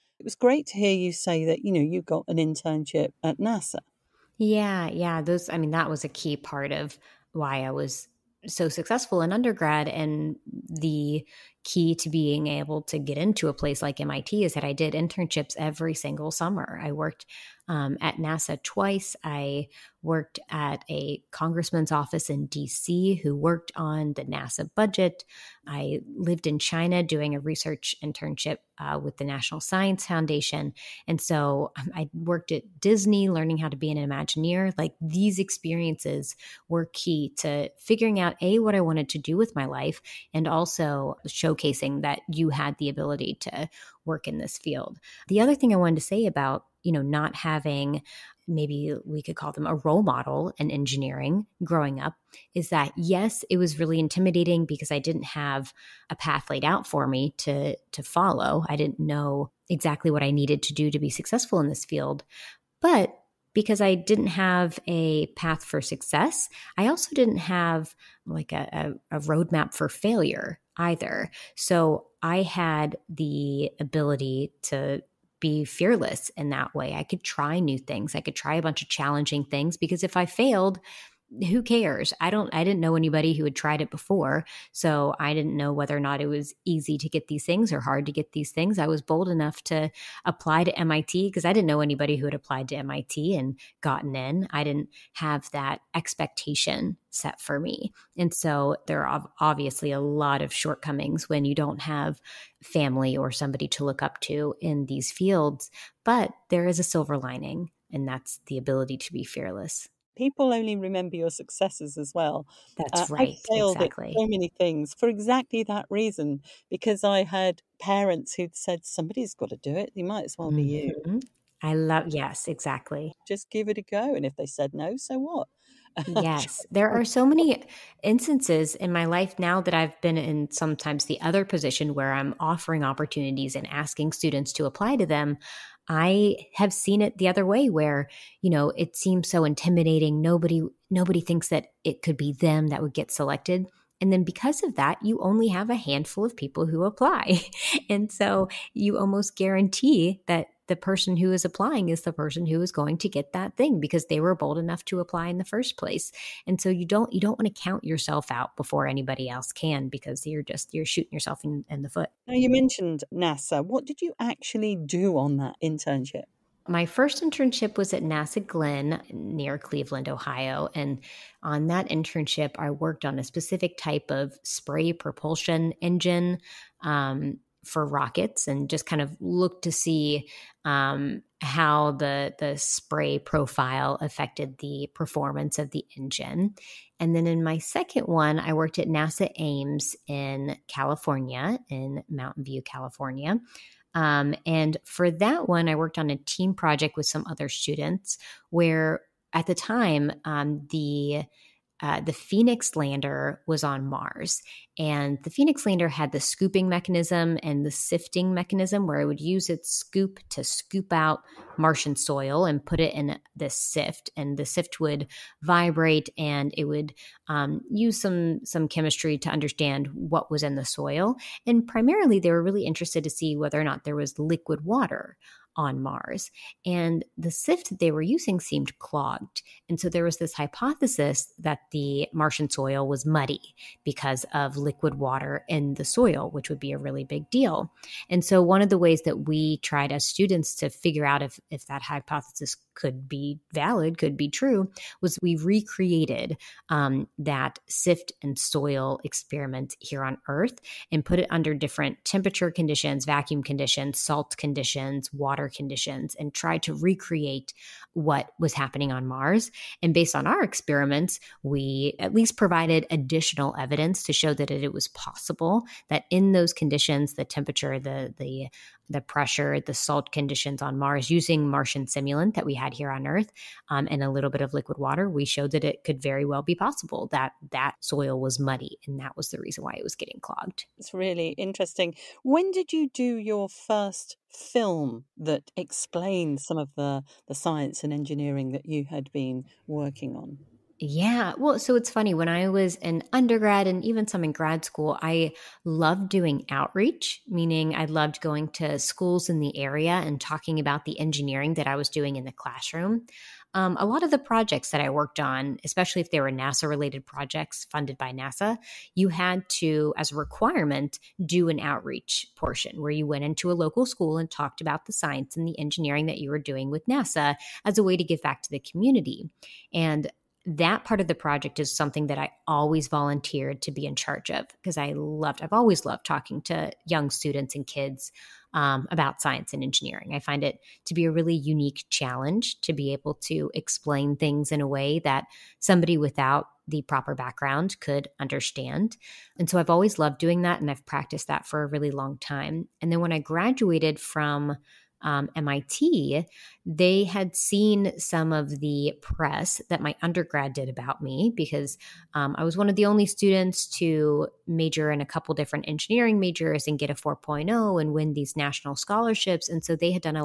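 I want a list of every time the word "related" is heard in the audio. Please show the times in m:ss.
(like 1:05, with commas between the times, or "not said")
5:06.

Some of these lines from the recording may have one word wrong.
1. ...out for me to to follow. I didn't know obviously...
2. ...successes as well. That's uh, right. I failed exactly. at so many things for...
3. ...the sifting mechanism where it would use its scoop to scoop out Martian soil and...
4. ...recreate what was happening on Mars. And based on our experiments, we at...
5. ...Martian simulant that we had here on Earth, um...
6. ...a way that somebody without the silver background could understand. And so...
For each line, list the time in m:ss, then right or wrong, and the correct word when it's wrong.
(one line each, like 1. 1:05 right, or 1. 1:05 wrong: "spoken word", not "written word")
1. 0:56 wrong: "exactly", not "obviously"
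2. 1:51 right
3. 3:27 right
4. 4:16 right
5. 4:31 right
6. 5:34 wrong: "proper", not "silver".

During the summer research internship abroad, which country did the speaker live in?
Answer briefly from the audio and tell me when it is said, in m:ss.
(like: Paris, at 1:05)
China, at 0:26.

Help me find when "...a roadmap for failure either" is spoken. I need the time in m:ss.
1:09.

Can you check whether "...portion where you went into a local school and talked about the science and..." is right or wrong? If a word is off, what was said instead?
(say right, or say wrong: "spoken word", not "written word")
right.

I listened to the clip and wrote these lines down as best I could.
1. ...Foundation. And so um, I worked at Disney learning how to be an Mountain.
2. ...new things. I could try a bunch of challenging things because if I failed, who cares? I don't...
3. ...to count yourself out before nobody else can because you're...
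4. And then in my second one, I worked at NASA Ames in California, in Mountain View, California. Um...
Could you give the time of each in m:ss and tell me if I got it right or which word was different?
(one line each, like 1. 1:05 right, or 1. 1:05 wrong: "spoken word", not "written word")
1. 0:30 wrong: "Imagineer", not "Mountain"
2. 1:17 right
3. 2:37 wrong: "anybody", not "nobody"
4. 3:06 right.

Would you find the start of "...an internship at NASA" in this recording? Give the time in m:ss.
0:02.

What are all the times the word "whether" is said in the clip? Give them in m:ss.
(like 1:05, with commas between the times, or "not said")
1:25, 3:43.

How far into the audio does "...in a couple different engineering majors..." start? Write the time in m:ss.
5:54.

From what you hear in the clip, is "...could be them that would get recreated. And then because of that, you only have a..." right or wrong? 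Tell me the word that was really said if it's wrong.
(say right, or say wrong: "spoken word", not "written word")
wrong: "selected", not "recreated".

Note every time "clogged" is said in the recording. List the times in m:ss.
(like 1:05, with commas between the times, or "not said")
3:48, 4:40.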